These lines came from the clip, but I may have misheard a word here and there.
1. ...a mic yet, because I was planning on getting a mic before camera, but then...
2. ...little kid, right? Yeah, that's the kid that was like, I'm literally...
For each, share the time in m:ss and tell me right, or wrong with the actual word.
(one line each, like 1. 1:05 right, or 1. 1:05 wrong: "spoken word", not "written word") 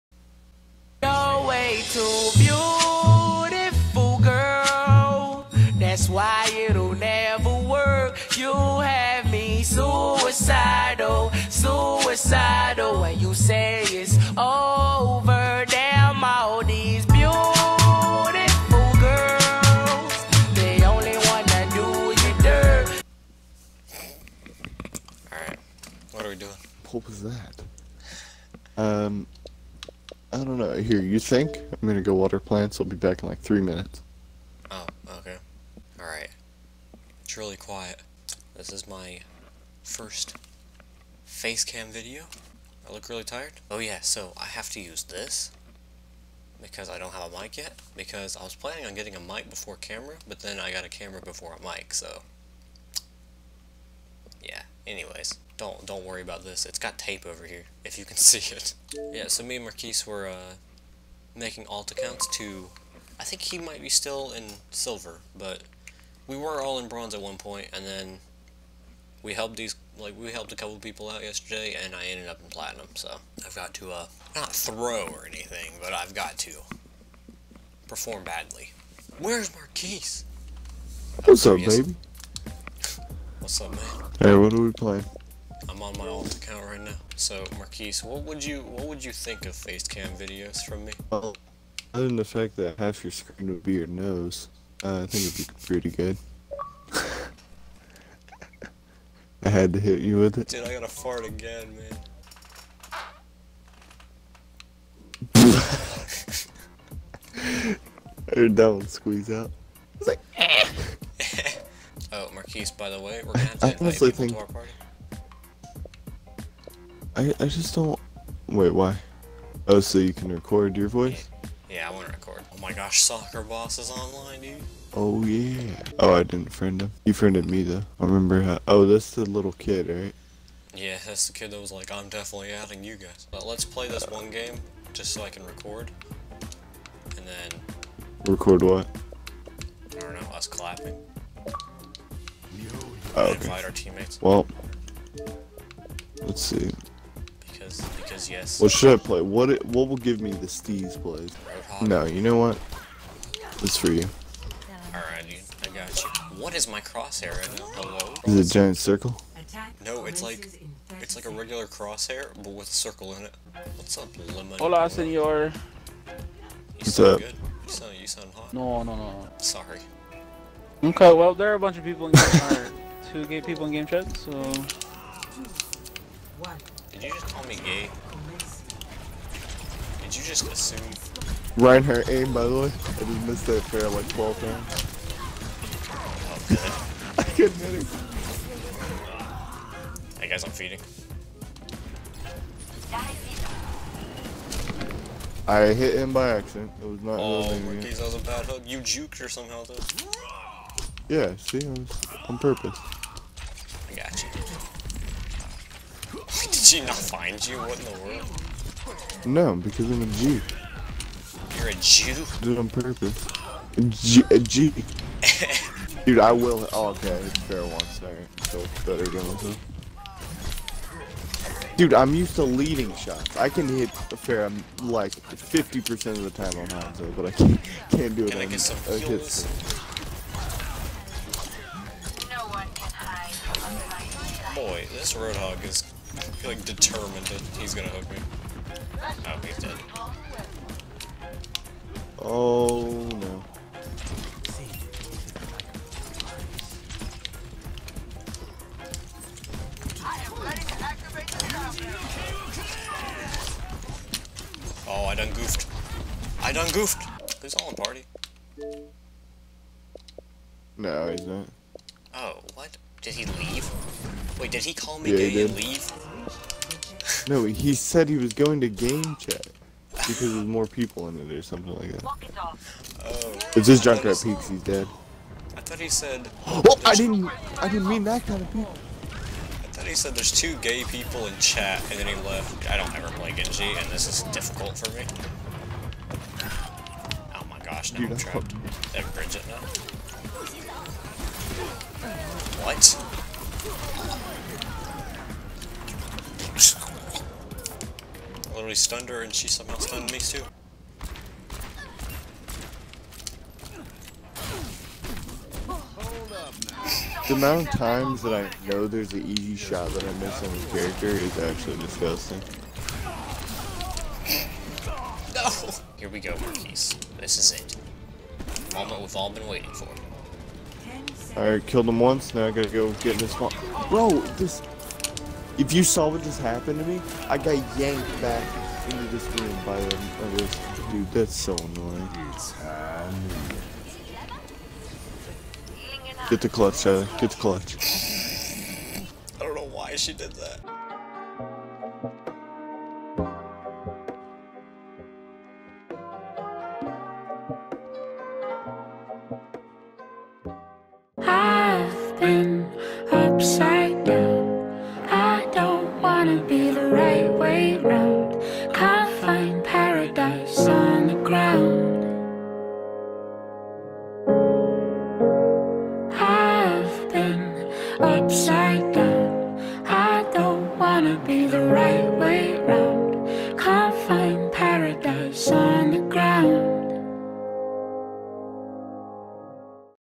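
1. 0:47 right
2. 2:09 wrong: "definitely", not "literally".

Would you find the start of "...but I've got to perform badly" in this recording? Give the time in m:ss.
1:15.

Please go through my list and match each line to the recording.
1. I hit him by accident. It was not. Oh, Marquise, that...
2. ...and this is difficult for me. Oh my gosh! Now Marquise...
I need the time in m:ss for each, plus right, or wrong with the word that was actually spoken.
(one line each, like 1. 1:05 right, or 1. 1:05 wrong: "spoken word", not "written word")
1. 3:15 right
2. 4:43 wrong: "Dude", not "Marquise".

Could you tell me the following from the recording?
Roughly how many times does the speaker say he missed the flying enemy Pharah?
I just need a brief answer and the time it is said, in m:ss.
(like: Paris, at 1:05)
12, at 3:04.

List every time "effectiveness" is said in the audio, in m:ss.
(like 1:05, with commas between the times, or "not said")
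not said.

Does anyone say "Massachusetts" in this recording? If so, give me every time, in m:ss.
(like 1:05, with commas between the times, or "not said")
not said.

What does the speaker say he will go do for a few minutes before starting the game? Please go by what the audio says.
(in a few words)
water plants.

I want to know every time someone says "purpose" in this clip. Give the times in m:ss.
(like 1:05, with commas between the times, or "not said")
3:22, 3:32.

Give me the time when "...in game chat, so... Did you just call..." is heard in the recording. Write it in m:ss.
2:53.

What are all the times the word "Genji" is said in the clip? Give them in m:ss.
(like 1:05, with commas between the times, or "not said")
4:43.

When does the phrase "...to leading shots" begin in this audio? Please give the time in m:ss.
3:42.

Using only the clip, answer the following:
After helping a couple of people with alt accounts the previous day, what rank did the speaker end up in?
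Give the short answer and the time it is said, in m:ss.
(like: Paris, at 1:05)
platinum, at 1:12.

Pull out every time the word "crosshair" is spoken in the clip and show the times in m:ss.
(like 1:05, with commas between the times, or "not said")
2:36, 2:41.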